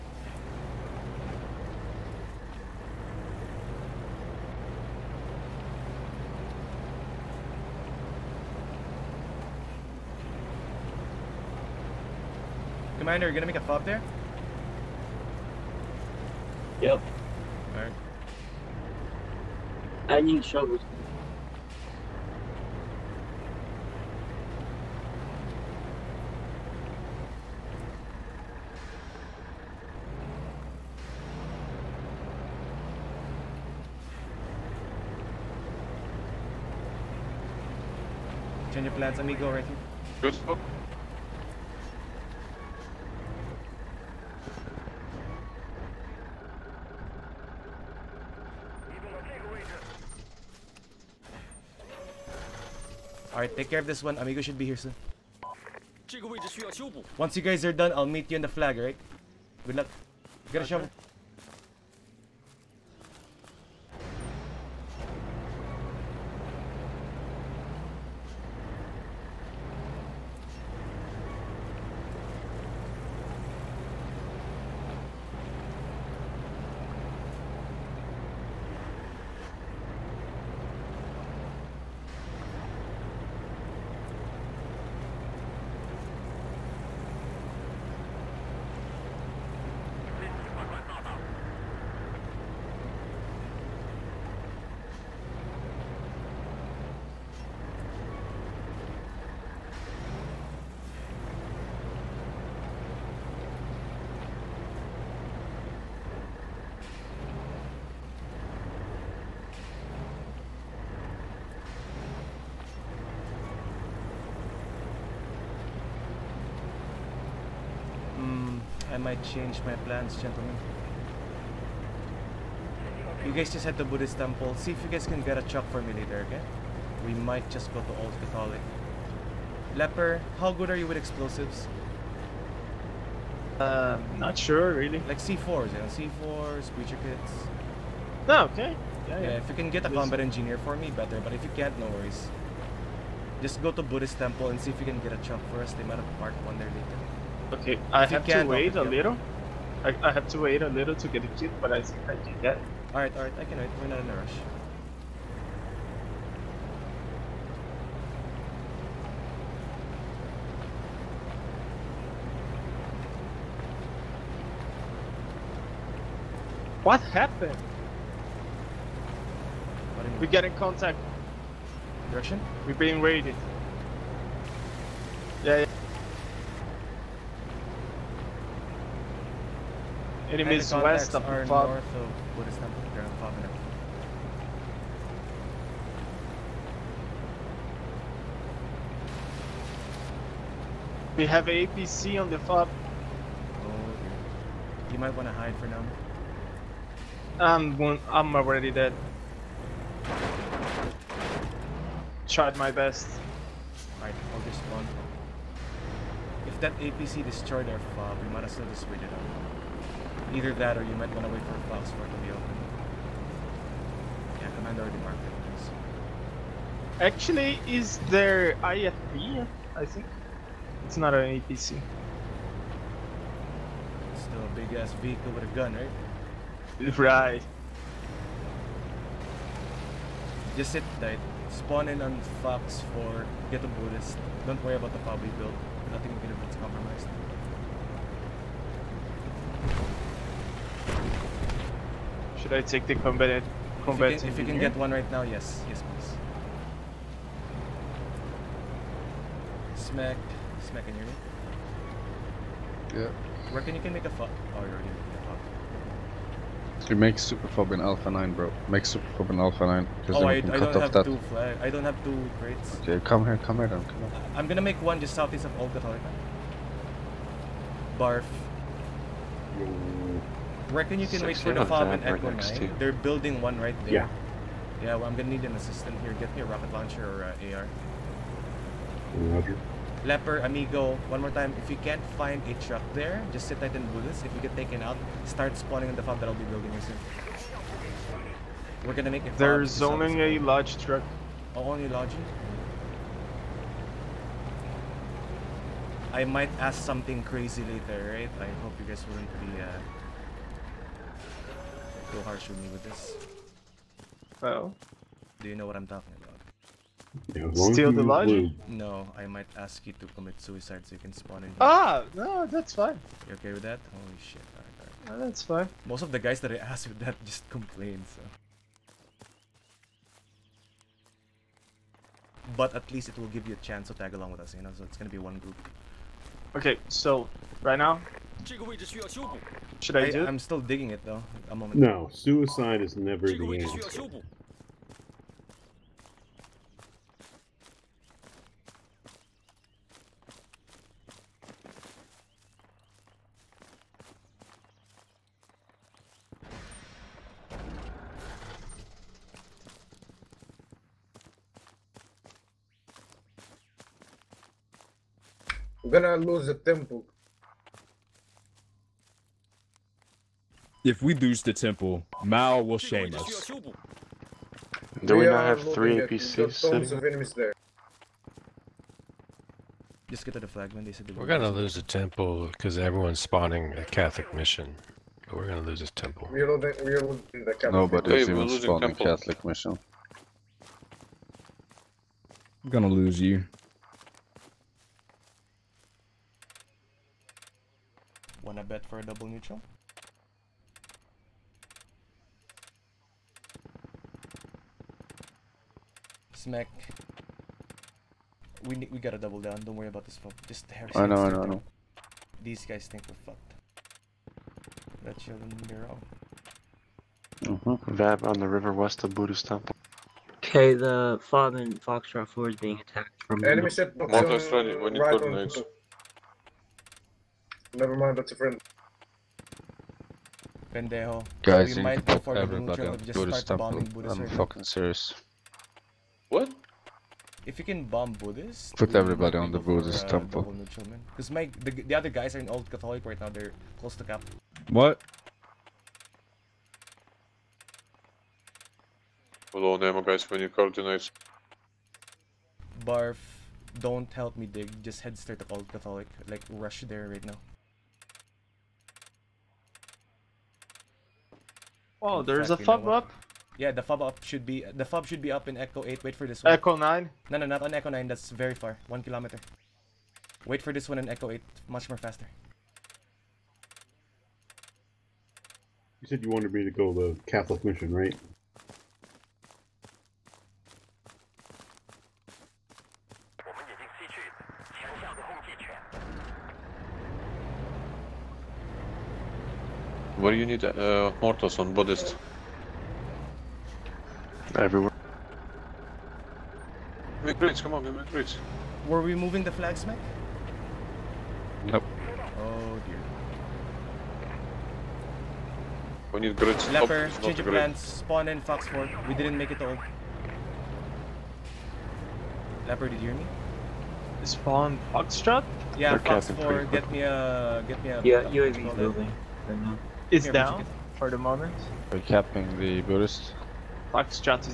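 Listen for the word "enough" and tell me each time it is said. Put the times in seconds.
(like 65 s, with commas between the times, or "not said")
not said.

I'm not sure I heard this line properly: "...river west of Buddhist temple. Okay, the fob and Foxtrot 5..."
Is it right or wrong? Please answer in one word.
wrong.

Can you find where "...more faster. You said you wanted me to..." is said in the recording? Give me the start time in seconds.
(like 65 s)
461 s.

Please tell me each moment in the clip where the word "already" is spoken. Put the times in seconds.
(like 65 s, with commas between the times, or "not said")
198 s, 214 s, 254 s.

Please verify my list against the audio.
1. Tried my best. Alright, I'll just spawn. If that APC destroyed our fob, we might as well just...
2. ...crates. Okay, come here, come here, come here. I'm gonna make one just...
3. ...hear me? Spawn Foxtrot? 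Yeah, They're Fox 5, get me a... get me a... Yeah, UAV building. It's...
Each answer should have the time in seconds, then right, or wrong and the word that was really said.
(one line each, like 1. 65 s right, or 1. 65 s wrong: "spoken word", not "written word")
1. 202 s right
2. 262 s right
3. 503 s wrong: "4", not "5".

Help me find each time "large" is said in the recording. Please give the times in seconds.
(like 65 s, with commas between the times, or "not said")
290 s.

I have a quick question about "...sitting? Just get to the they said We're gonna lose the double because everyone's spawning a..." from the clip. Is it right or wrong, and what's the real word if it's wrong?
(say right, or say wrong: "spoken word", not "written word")
wrong: "temple", not "double".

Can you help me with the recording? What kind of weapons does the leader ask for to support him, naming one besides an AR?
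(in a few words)
Rocket launcher.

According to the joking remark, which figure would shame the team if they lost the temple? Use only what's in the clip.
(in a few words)
Mao.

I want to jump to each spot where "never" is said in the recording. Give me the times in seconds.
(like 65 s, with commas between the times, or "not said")
332 s, 417 s.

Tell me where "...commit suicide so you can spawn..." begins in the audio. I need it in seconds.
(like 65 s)
310 s.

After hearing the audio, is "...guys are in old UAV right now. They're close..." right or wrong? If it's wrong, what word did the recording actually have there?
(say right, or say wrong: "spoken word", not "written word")
wrong: "Catholic", not "UAV".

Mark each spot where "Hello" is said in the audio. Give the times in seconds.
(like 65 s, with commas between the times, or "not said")
439 s.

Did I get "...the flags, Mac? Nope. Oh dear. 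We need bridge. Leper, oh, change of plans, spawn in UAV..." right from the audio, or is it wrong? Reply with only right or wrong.
wrong.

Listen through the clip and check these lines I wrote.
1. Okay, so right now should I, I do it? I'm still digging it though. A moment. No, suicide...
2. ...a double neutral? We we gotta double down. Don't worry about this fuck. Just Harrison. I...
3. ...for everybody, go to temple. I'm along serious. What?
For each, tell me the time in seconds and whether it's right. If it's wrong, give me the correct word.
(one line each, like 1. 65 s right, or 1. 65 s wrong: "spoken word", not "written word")
1. 326 s right
2. 388 s right
3. 422 s wrong: "fucking", not "along".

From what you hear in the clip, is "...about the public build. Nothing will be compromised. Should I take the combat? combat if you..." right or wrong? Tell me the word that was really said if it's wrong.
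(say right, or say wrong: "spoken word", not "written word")
right.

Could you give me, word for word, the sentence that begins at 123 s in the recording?
You guys just head to Buddhist temple.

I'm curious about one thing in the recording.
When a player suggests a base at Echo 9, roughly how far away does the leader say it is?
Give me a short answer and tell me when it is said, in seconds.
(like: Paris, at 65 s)
One kilometer, at 458 s.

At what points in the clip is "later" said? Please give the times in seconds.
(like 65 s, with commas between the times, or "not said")
125 s, 146 s, 297 s.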